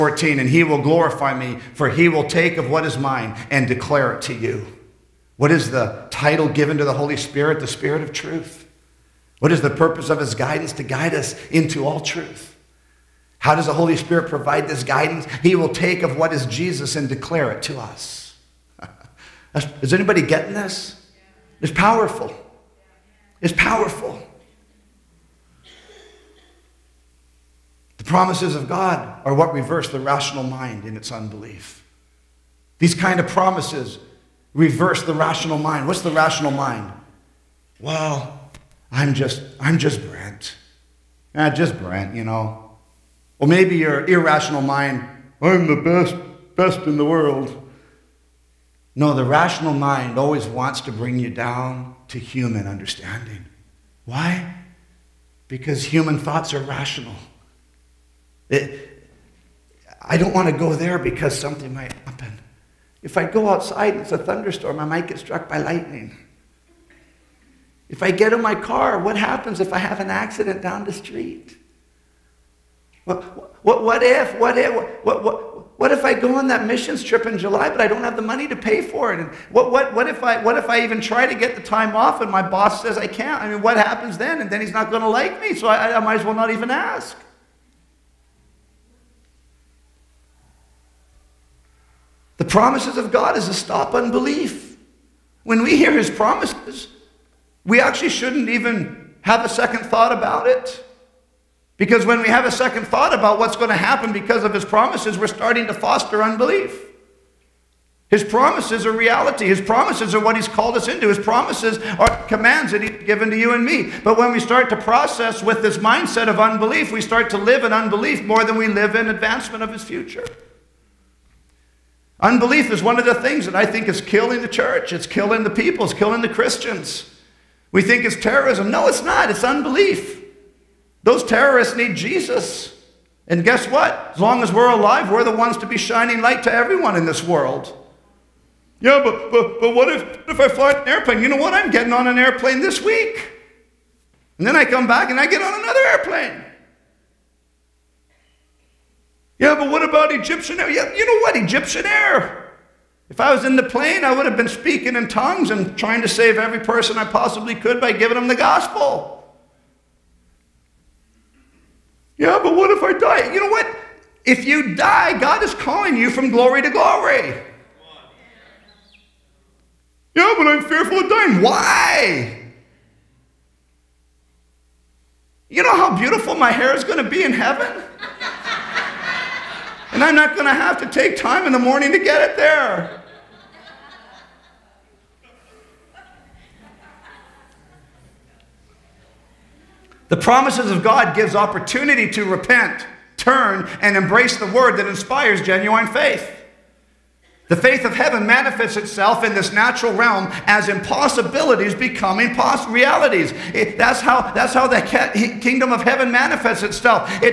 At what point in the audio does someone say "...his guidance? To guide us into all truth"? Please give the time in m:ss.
0:10.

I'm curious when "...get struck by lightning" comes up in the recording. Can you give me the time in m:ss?
1:05.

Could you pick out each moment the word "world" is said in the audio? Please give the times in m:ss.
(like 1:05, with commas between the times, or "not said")
0:47, 2:17.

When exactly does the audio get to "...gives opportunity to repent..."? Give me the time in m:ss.
3:11.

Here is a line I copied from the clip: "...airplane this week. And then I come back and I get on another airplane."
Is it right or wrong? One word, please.
right.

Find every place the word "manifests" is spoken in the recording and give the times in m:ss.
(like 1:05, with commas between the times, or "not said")
3:18, 3:26.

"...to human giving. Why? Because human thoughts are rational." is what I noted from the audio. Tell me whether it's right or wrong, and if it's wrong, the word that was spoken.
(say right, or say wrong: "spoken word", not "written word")
wrong: "understanding", not "giving".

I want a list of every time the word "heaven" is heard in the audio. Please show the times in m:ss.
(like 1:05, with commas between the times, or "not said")
2:57, 3:17, 3:25.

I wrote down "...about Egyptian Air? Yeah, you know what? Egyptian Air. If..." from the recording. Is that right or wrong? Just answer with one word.
right.